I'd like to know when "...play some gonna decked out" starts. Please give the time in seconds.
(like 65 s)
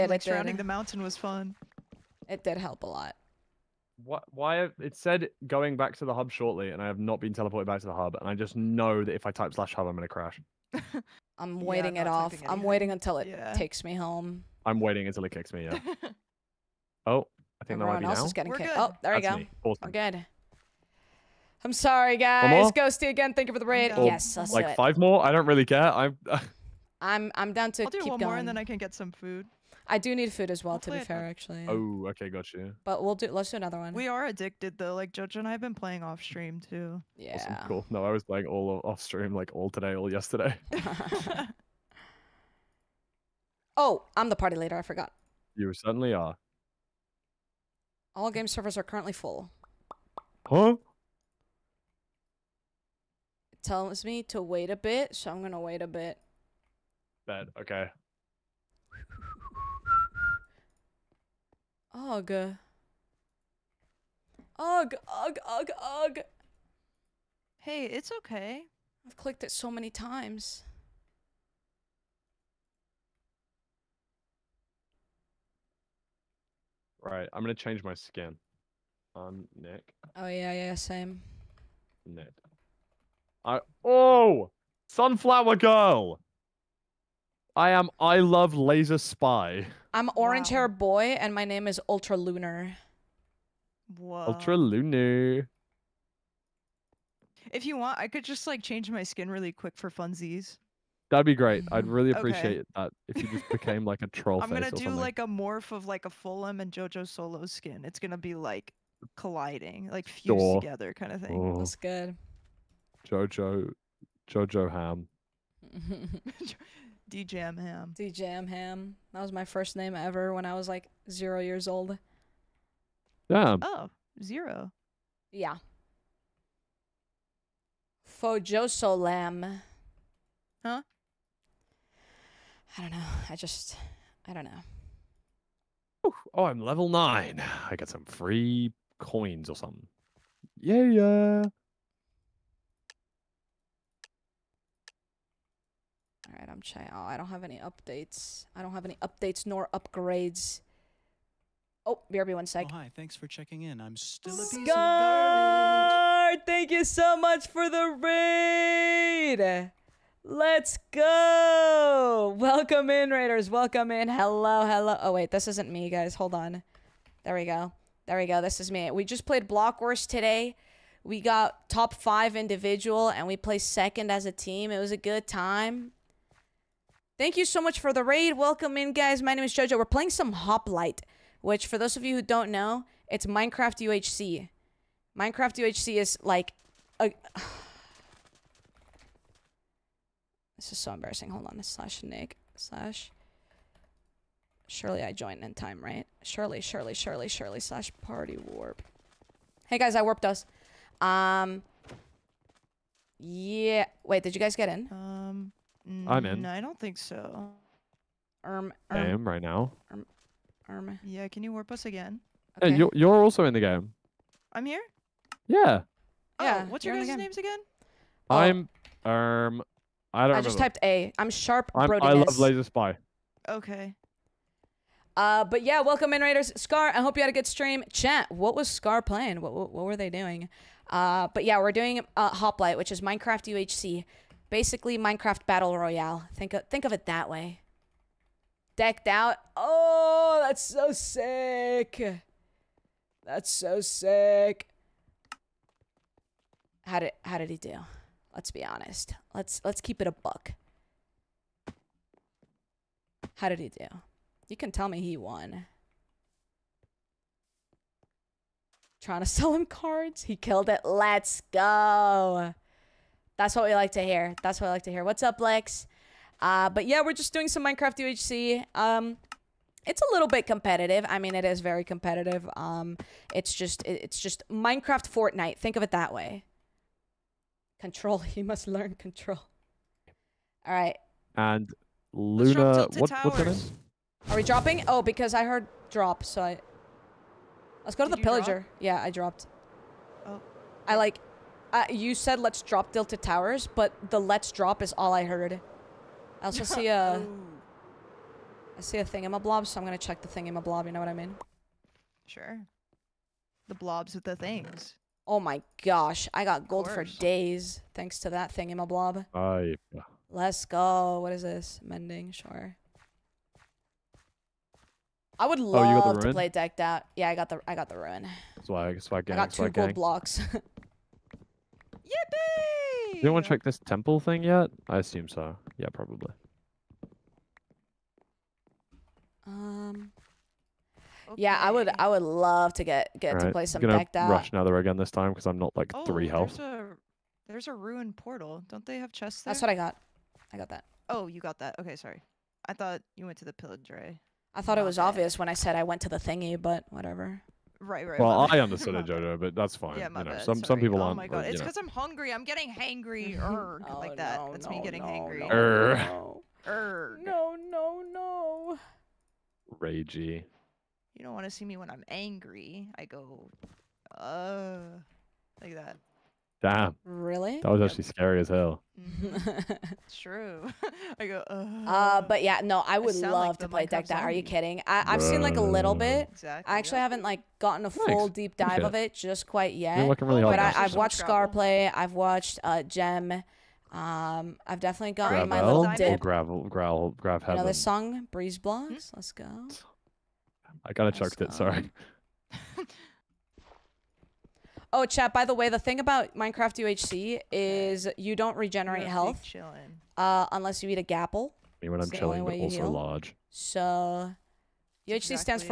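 333 s.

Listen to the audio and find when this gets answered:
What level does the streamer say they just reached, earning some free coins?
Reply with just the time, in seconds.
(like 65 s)
136 s.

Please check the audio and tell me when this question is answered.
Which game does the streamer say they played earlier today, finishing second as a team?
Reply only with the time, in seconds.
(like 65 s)
169 s.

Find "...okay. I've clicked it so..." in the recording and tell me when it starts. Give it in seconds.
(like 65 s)
68 s.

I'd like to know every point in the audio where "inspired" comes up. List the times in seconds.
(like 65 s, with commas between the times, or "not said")
not said.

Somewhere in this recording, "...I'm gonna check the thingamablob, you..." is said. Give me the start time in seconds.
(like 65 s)
299 s.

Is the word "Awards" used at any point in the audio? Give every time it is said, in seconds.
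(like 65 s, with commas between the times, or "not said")
not said.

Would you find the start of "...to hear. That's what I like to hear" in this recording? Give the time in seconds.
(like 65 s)
263 s.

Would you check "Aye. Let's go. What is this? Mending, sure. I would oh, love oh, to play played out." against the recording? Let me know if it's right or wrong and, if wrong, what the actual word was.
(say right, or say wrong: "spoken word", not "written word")
wrong: "decked", not "played".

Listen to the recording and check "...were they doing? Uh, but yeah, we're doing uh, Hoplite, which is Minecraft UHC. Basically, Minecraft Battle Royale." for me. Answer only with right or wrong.
right.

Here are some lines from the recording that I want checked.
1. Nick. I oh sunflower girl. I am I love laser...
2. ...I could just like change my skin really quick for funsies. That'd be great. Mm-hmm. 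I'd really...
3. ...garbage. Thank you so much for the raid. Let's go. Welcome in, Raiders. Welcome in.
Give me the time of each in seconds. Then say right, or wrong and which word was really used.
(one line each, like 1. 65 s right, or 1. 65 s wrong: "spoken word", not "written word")
1. 82 s right
2. 97 s right
3. 154 s right.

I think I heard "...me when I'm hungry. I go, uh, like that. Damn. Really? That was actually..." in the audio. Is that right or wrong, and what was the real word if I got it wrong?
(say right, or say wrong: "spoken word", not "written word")
wrong: "angry", not "hungry".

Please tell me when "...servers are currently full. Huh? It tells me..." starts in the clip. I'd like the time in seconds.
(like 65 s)
48 s.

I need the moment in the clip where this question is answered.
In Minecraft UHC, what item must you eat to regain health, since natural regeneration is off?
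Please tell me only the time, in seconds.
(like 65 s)
400 s.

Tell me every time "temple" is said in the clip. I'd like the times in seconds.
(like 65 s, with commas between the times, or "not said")
323 s.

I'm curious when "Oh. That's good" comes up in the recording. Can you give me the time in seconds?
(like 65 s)
111 s.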